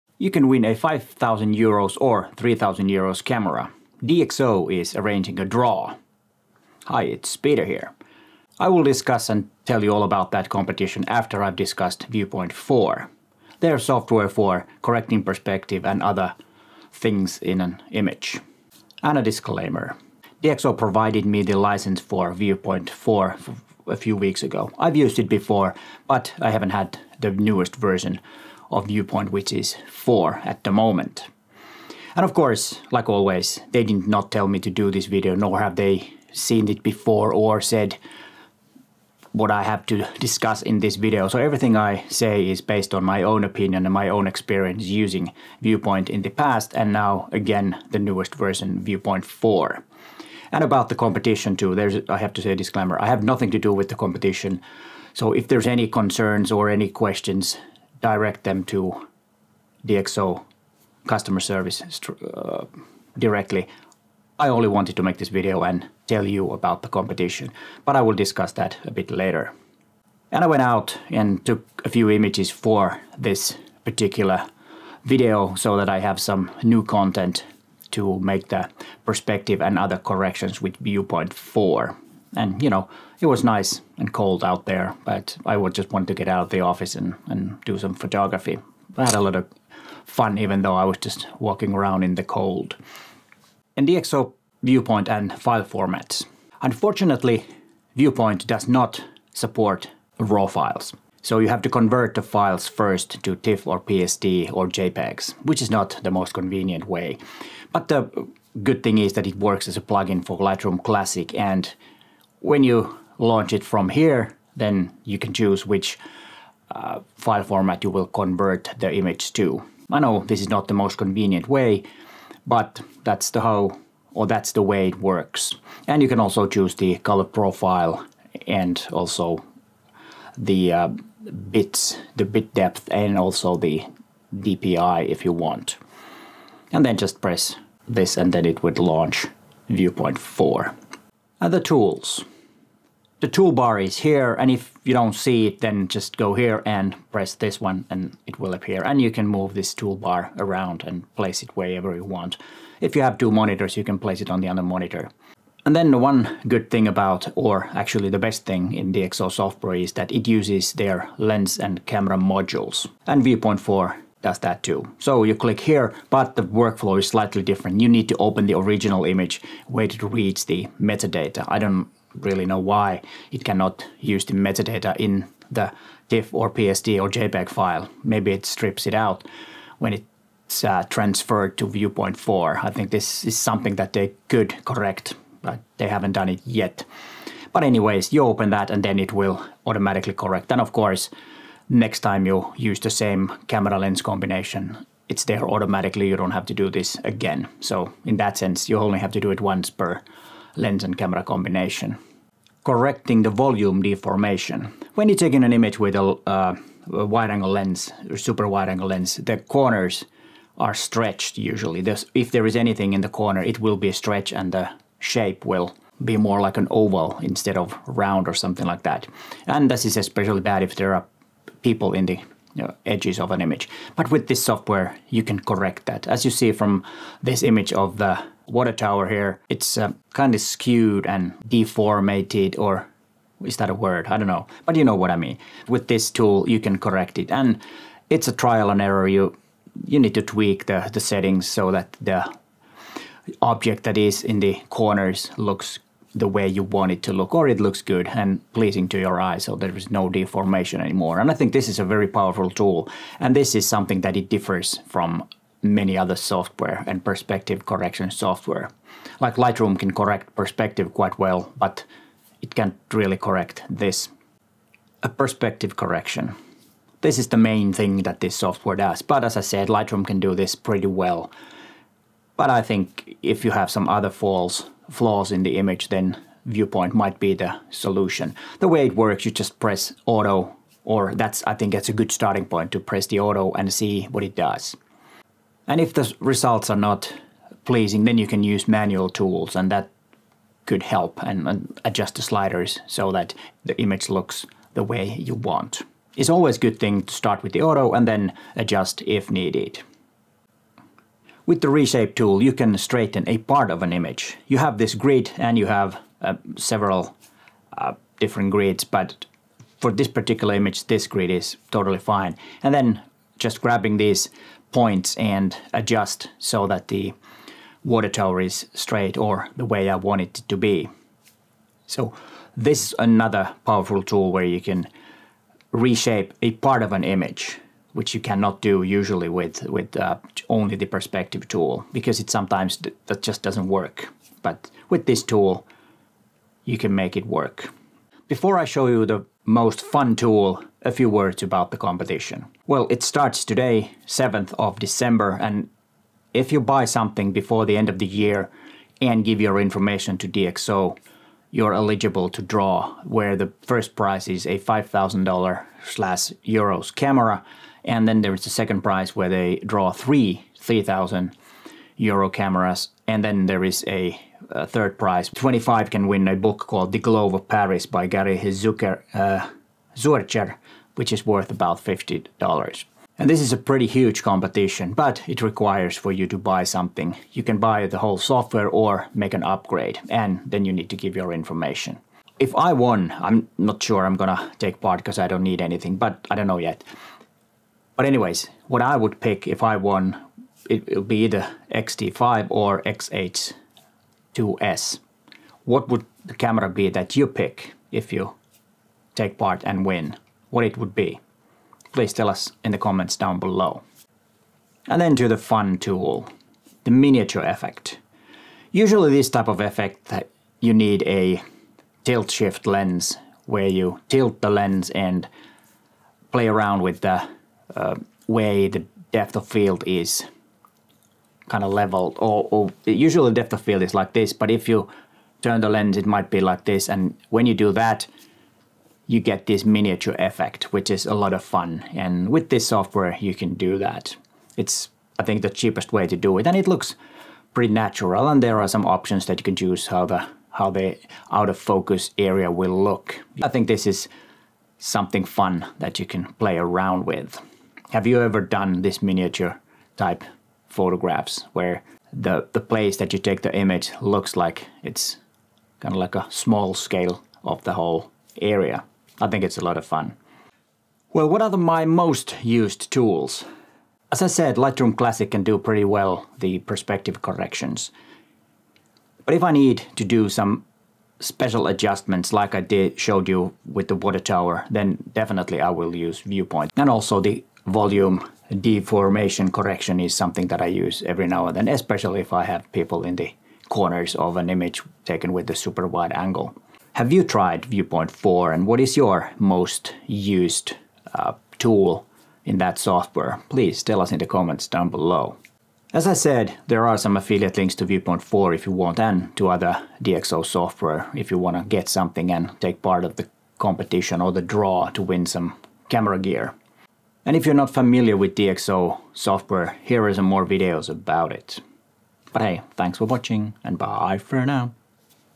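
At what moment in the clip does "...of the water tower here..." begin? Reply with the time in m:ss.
3:47.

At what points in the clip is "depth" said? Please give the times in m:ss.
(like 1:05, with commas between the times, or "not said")
2:12, 6:59, 7:03.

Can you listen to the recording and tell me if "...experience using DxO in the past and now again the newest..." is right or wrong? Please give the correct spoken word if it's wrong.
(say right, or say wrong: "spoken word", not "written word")
wrong: "Viewpoint", not "DxO".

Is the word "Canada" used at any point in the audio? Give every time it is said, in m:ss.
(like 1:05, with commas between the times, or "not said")
not said.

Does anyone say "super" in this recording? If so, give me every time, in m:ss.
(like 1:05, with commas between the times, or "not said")
3:28, 8:05.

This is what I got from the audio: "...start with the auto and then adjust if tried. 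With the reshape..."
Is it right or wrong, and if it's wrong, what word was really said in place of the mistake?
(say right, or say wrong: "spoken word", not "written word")
wrong: "needed", not "tried".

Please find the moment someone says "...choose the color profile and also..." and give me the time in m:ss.
2:06.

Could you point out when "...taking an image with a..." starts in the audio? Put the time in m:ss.
3:25.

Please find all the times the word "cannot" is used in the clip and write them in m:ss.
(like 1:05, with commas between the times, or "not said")
2:53, 5:28.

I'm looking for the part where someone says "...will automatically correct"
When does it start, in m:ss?
3:09.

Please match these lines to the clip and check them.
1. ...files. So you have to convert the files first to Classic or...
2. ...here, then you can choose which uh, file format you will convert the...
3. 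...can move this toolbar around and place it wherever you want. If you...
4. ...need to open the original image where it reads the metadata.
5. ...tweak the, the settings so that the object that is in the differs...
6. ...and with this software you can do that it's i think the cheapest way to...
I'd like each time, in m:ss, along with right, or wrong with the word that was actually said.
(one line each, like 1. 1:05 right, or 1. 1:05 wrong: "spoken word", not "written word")
1. 1:40 wrong: "TIFF", not "Classic"
2. 1:53 right
3. 2:29 right
4. 2:47 right
5. 4:00 wrong: "corners", not "differs"
6. 7:11 right.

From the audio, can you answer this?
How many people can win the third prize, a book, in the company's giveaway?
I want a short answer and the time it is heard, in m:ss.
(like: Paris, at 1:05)
25, at 6:05.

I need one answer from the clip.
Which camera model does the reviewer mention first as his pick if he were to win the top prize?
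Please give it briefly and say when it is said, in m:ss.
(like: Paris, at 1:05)
XT5, at 6:31.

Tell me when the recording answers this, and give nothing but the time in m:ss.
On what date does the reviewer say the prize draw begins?
5:44.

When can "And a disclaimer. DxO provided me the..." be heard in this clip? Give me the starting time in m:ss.
0:19.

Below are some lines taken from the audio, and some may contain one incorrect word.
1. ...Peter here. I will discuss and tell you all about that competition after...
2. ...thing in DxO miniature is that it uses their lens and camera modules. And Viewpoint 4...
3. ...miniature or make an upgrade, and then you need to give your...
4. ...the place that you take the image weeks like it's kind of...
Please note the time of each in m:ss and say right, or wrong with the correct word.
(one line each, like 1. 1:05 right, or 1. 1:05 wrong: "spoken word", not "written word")
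1. 0:07 right
2. 2:38 wrong: "software", not "miniature"
3. 6:18 wrong: "software", not "miniature"
4. 7:32 wrong: "looks", not "weeks".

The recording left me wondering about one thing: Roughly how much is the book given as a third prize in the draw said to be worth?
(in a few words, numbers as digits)
$50.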